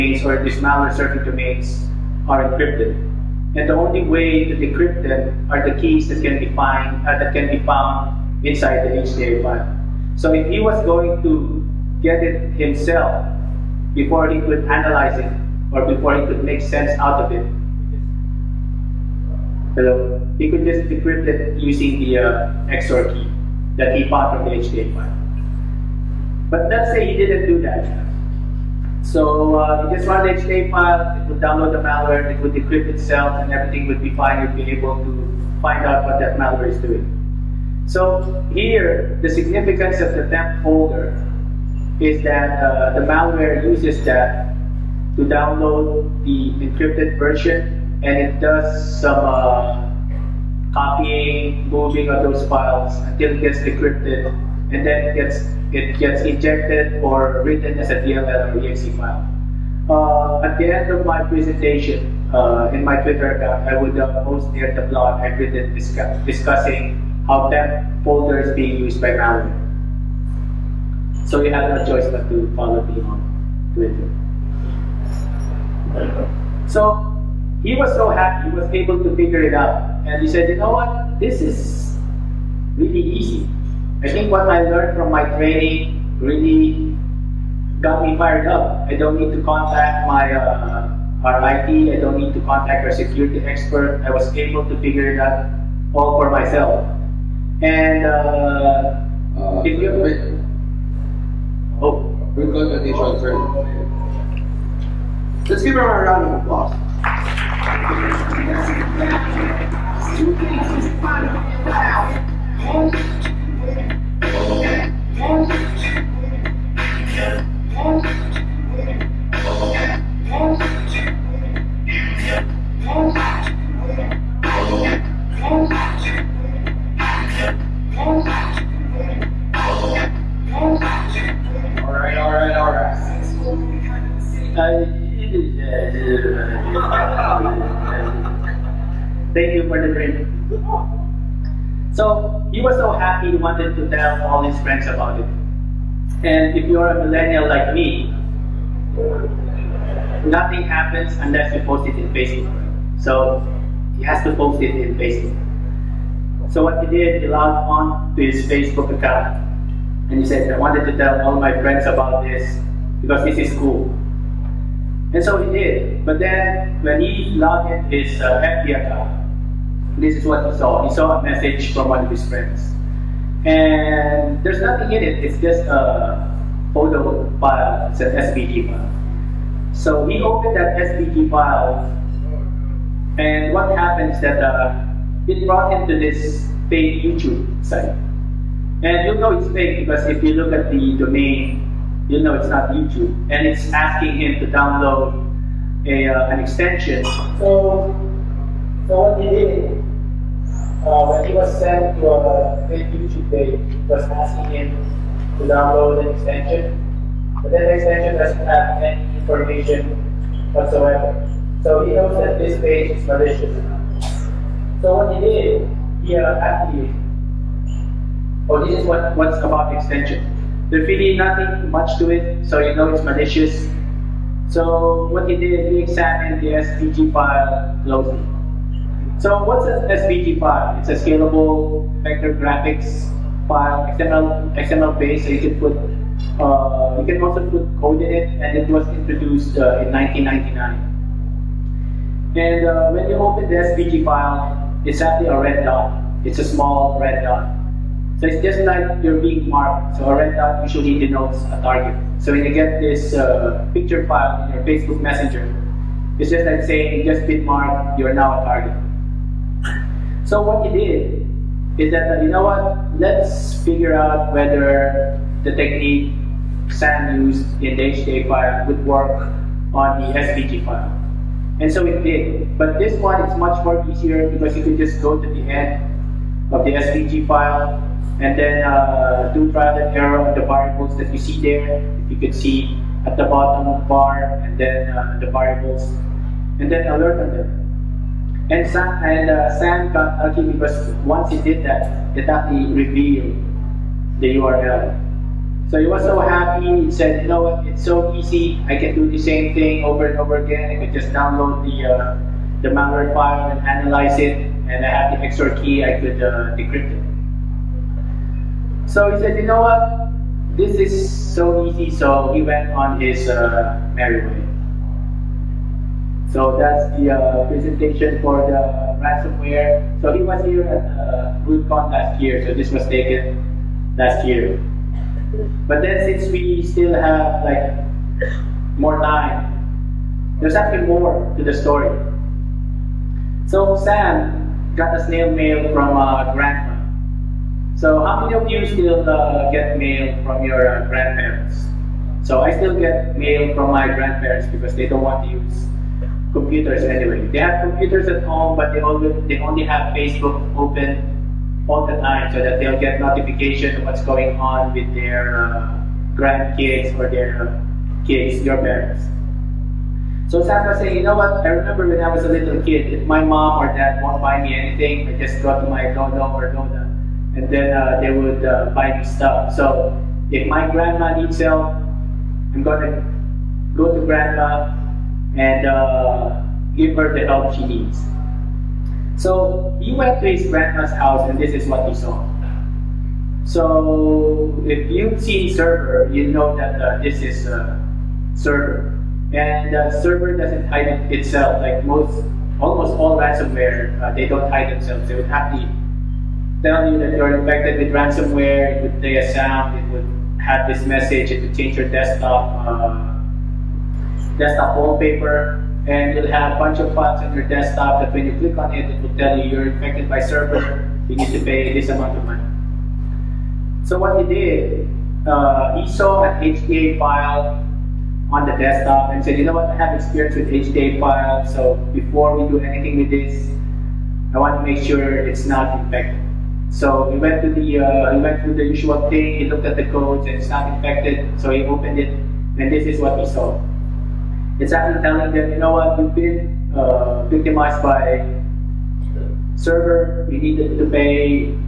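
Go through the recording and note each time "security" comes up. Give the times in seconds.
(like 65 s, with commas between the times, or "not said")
92 s.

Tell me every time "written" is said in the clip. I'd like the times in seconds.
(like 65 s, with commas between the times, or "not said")
57 s, 65 s.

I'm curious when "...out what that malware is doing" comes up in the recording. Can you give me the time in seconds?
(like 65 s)
35 s.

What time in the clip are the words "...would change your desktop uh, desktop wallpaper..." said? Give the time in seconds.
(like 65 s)
401 s.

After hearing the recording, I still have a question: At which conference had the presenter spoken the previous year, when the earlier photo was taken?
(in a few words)
RootCon.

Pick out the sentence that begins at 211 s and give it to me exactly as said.
So he knows that this page is malicious.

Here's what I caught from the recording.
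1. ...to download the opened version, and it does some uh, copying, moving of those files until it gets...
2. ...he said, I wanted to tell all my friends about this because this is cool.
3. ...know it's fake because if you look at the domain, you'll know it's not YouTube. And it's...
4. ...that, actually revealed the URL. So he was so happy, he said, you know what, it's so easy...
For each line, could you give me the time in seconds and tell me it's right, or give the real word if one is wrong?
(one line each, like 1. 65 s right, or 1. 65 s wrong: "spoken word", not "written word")
1. 45 s wrong: "encrypted", not "opened"
2. 160 s right
3. 189 s right
4. 291 s right.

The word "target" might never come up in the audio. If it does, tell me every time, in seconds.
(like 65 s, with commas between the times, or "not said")
251 s, 258 s.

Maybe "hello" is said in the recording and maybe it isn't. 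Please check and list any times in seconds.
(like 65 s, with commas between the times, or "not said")
19 s.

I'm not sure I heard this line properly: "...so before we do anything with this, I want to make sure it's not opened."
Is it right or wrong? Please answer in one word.
wrong.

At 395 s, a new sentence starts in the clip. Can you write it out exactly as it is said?
They would happily tell you that you're infected with ransomware.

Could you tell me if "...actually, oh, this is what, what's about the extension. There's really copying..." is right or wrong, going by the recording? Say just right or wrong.
wrong.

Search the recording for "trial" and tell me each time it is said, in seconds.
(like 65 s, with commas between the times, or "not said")
279 s.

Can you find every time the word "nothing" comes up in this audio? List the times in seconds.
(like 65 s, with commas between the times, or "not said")
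150 s, 174 s, 221 s.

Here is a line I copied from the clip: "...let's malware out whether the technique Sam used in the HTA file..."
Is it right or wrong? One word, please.
wrong.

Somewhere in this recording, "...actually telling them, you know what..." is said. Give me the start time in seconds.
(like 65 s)
434 s.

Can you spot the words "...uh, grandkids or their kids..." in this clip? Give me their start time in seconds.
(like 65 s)
355 s.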